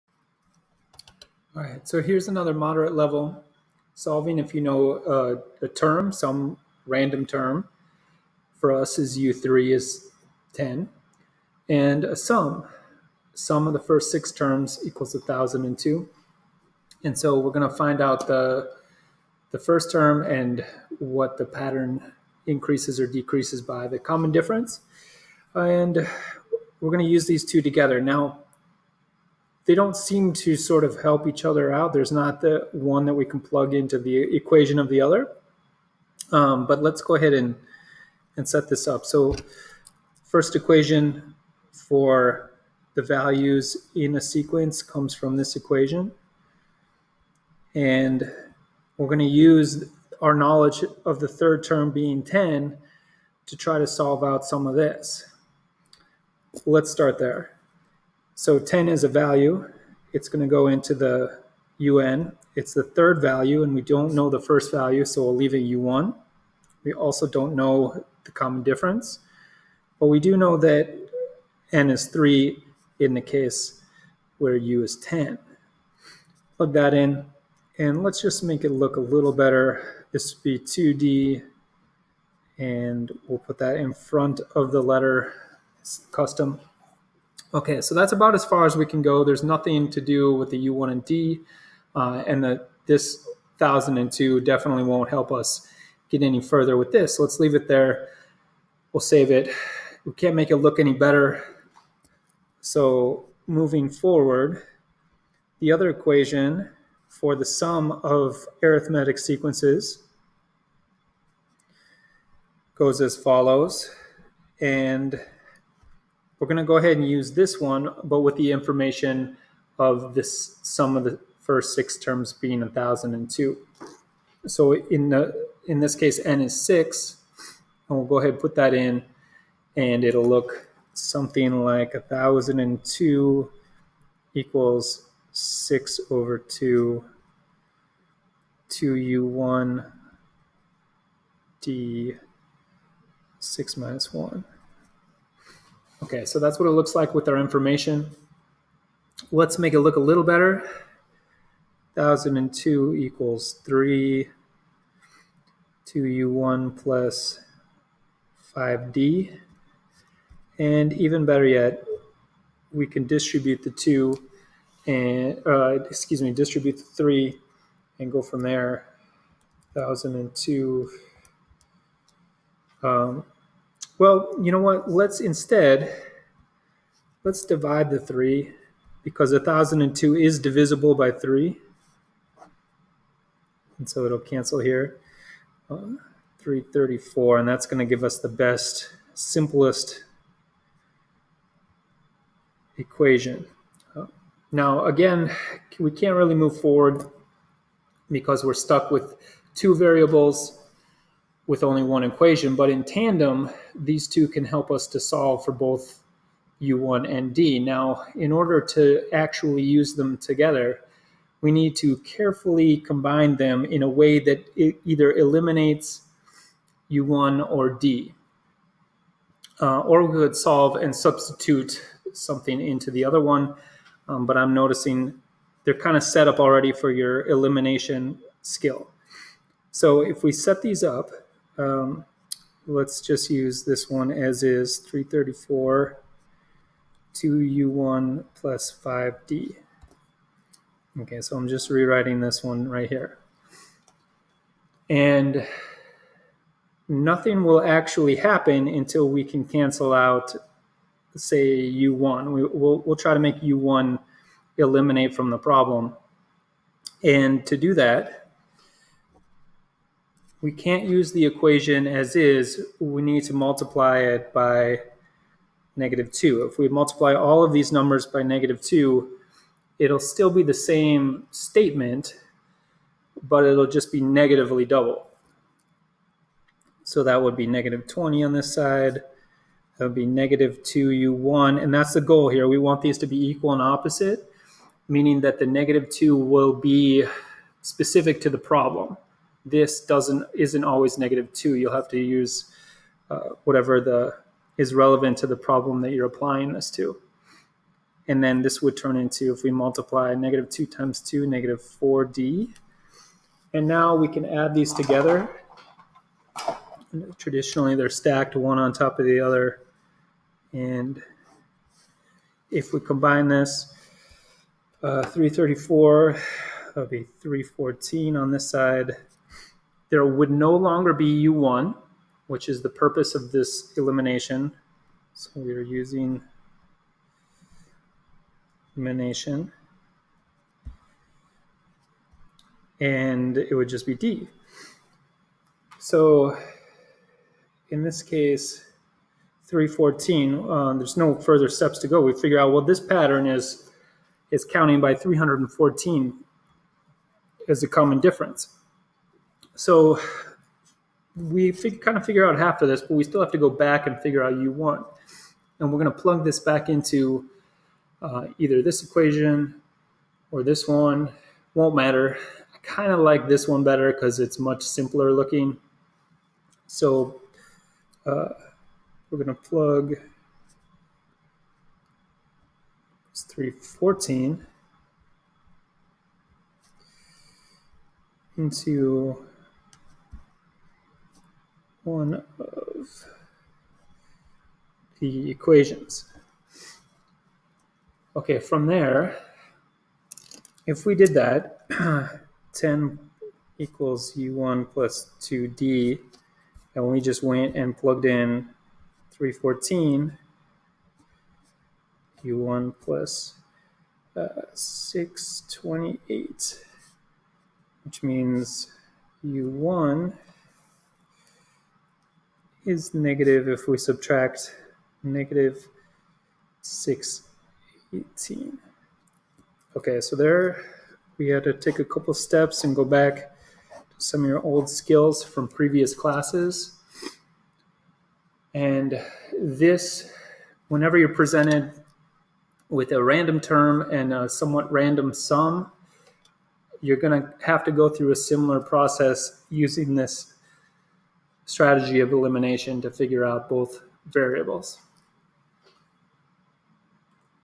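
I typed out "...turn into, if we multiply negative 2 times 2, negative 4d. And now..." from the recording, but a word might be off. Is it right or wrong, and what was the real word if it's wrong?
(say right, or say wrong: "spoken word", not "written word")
right.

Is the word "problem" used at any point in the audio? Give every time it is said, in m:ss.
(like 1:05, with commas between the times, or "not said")
4:15, 4:48, 4:55.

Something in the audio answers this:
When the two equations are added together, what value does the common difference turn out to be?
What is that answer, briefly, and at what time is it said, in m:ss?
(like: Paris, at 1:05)
314, at 5:39.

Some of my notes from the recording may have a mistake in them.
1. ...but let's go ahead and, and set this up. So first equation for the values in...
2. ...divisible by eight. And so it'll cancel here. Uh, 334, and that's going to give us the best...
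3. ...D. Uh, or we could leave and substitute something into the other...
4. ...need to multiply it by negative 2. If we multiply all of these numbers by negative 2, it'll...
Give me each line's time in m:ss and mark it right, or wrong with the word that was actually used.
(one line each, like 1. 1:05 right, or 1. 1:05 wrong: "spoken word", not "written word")
1. 0:36 right
2. 3:00 wrong: "three", not "eight"
3. 3:37 wrong: "solve", not "leave"
4. 4:23 right.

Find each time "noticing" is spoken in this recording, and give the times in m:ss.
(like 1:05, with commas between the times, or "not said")
3:44.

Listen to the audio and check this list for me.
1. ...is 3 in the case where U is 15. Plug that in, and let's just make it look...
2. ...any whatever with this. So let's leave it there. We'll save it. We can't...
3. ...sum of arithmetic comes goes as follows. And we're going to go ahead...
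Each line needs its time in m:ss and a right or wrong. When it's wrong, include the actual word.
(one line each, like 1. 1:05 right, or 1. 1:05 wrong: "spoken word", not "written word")
1. 1:11 wrong: "10", not "15"
2. 1:36 wrong: "further", not "whatever"
3. 1:47 wrong: "sequences", not "comes".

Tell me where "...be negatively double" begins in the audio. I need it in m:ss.
4:33.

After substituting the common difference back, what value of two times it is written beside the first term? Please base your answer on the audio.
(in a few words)
628.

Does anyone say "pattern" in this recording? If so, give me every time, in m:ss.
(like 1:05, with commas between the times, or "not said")
0:21, 5:42.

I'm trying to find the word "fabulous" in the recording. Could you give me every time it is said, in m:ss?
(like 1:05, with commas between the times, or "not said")
not said.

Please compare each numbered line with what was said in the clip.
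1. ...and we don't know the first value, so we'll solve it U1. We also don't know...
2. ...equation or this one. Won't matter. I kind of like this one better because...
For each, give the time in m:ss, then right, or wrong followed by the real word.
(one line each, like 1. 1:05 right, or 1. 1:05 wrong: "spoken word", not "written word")
1. 1:03 wrong: "leave", not "solve"
2. 5:58 right.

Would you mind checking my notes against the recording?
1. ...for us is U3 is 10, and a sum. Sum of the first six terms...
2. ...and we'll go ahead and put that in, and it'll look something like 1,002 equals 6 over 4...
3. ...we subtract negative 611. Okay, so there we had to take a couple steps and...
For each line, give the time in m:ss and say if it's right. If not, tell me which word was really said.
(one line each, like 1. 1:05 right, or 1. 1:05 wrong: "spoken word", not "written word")
1. 0:08 right
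2. 2:07 wrong: "2", not "4"
3. 6:53 wrong: "618", not "611".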